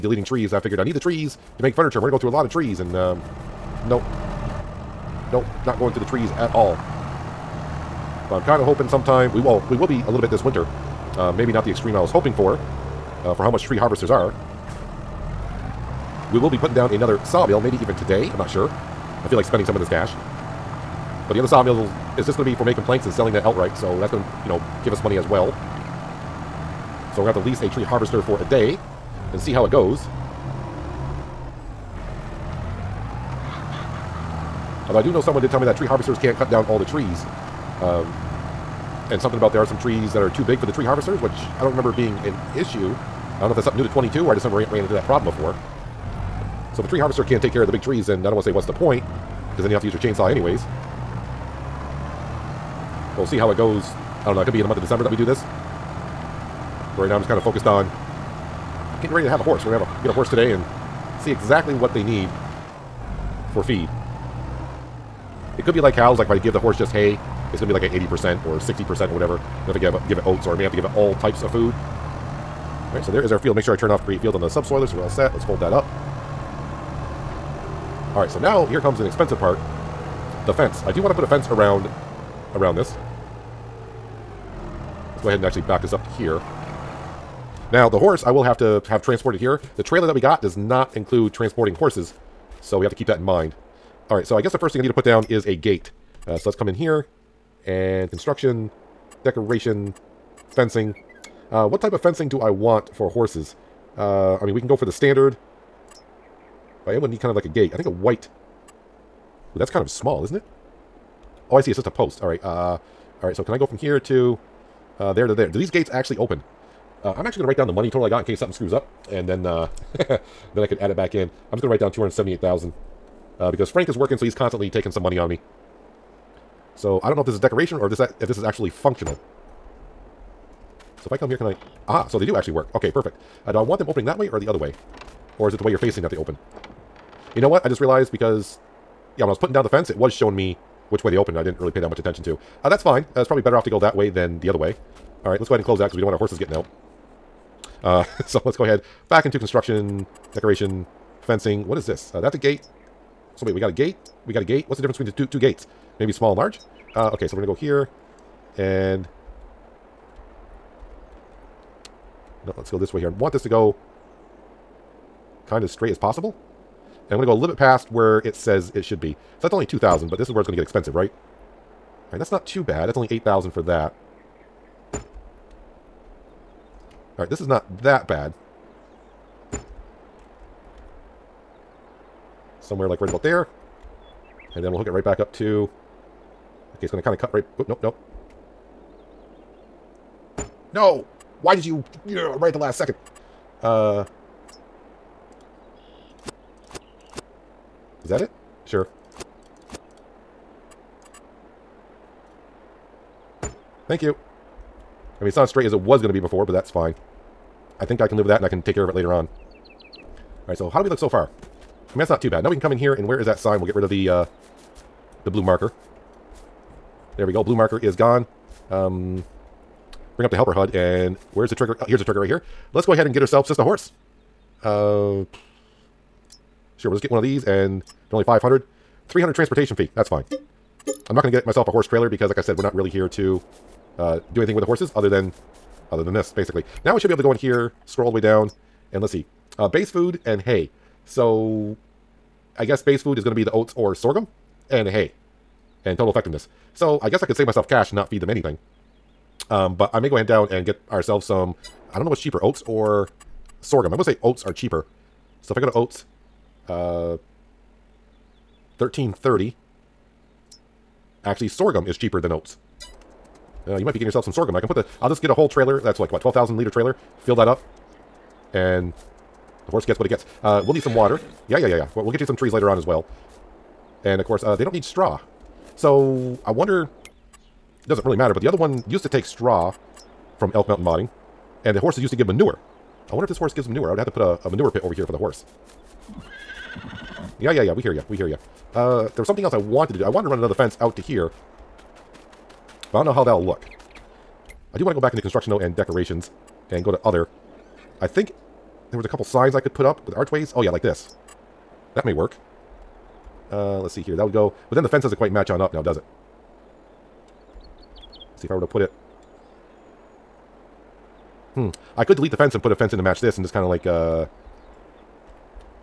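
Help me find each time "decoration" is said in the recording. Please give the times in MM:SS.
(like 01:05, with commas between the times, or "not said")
01:39, 02:07, 02:30, 04:55.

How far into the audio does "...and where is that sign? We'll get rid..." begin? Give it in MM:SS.
03:32.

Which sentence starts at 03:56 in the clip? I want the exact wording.
Now we should be able to go in here, scroll all the way down, and let's see.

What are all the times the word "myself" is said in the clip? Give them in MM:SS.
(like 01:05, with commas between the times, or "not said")
03:51, 04:07.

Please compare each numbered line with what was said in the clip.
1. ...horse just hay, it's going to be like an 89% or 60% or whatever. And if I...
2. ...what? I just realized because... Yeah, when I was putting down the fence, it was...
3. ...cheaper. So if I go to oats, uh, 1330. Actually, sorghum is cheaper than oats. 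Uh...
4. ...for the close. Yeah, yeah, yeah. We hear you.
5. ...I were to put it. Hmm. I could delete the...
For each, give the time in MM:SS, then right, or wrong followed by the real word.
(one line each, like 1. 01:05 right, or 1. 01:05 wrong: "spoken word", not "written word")
1. 01:06 wrong: "80", not "89"
2. 02:17 right
3. 04:14 right
4. 04:45 wrong: "horse", not "close"
5. 05:08 right.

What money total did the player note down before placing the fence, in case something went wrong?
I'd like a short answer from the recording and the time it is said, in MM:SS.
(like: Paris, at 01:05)
278,000, at 02:01.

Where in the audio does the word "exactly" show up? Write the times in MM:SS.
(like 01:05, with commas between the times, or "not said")
01:01.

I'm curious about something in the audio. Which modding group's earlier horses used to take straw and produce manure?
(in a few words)
Elk Mountain Modding.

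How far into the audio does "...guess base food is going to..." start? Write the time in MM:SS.
04:02.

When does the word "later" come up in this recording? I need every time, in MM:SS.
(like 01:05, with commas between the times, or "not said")
03:28, 04:32.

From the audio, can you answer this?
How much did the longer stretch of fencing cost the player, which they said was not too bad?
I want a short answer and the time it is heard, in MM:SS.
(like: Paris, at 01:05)
8,000, at 02:53.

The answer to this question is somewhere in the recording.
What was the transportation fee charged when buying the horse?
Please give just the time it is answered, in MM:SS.
03:49.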